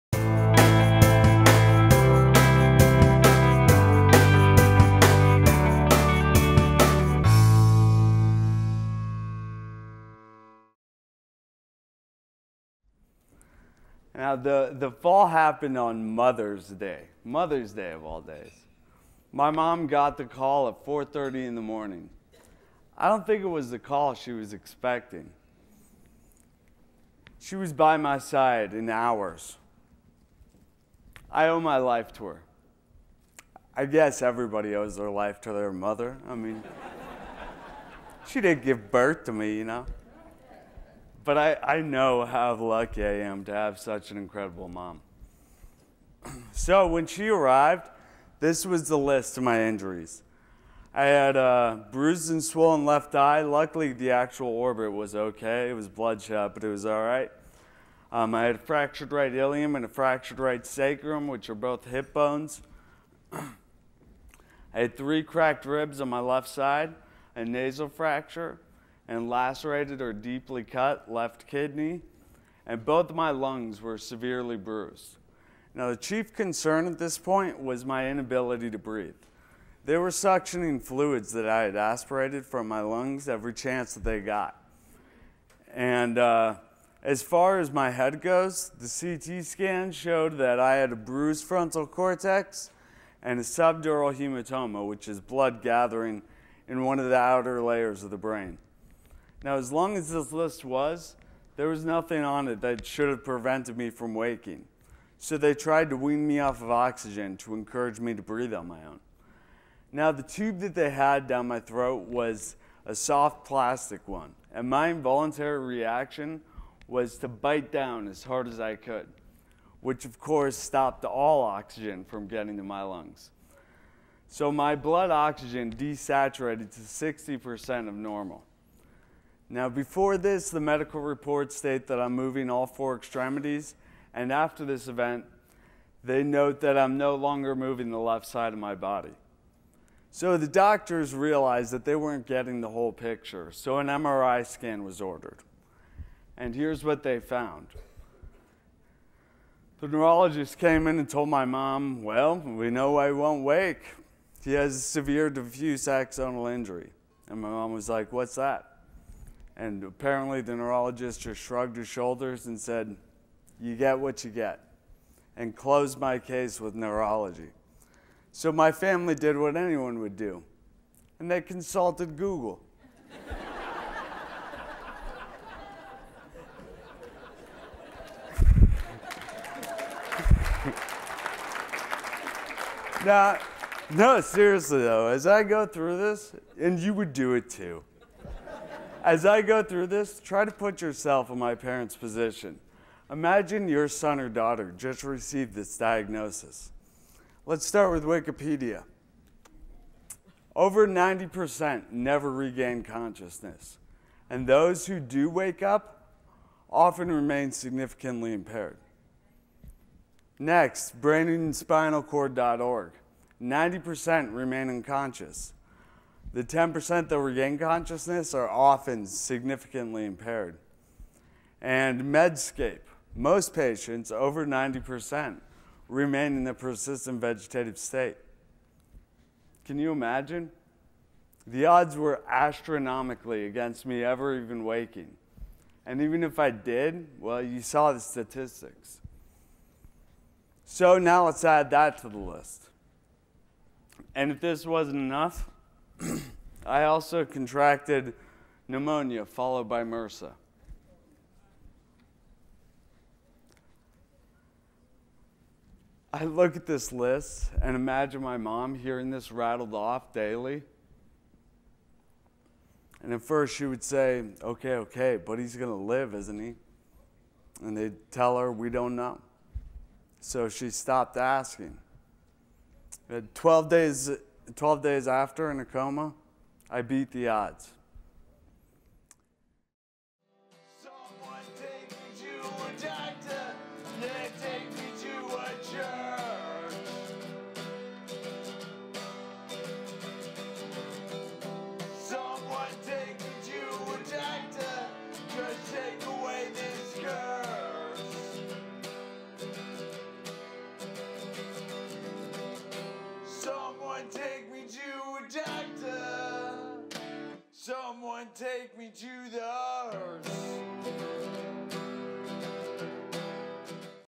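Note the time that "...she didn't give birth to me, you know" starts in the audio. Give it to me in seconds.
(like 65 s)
38 s.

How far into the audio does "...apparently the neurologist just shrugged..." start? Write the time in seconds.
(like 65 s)
159 s.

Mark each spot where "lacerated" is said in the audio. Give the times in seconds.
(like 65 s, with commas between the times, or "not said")
69 s.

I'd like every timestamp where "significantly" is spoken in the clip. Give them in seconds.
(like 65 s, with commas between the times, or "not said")
207 s, 219 s.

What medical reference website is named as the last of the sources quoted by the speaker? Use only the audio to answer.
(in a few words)
Medscape.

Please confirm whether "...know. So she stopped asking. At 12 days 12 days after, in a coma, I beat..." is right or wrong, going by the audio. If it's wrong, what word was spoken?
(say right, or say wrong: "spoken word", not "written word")
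right.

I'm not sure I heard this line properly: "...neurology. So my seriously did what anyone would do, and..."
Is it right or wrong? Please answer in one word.
wrong.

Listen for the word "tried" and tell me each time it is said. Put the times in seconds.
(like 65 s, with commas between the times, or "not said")
105 s.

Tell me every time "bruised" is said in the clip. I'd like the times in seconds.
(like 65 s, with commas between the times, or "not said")
51 s, 74 s, 90 s.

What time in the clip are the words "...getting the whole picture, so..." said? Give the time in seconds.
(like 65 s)
142 s.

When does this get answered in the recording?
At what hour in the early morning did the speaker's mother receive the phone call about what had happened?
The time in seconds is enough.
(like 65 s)
20 s.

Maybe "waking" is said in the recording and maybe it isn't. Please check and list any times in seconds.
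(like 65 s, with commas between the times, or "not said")
104 s, 234 s.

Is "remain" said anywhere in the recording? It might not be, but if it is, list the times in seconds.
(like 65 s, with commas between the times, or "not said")
207 s, 214 s, 225 s.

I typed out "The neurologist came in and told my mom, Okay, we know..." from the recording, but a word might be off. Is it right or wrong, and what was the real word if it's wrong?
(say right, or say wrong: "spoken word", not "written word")
wrong: "Well", not "Okay".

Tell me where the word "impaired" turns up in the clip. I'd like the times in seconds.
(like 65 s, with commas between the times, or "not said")
208 s, 220 s.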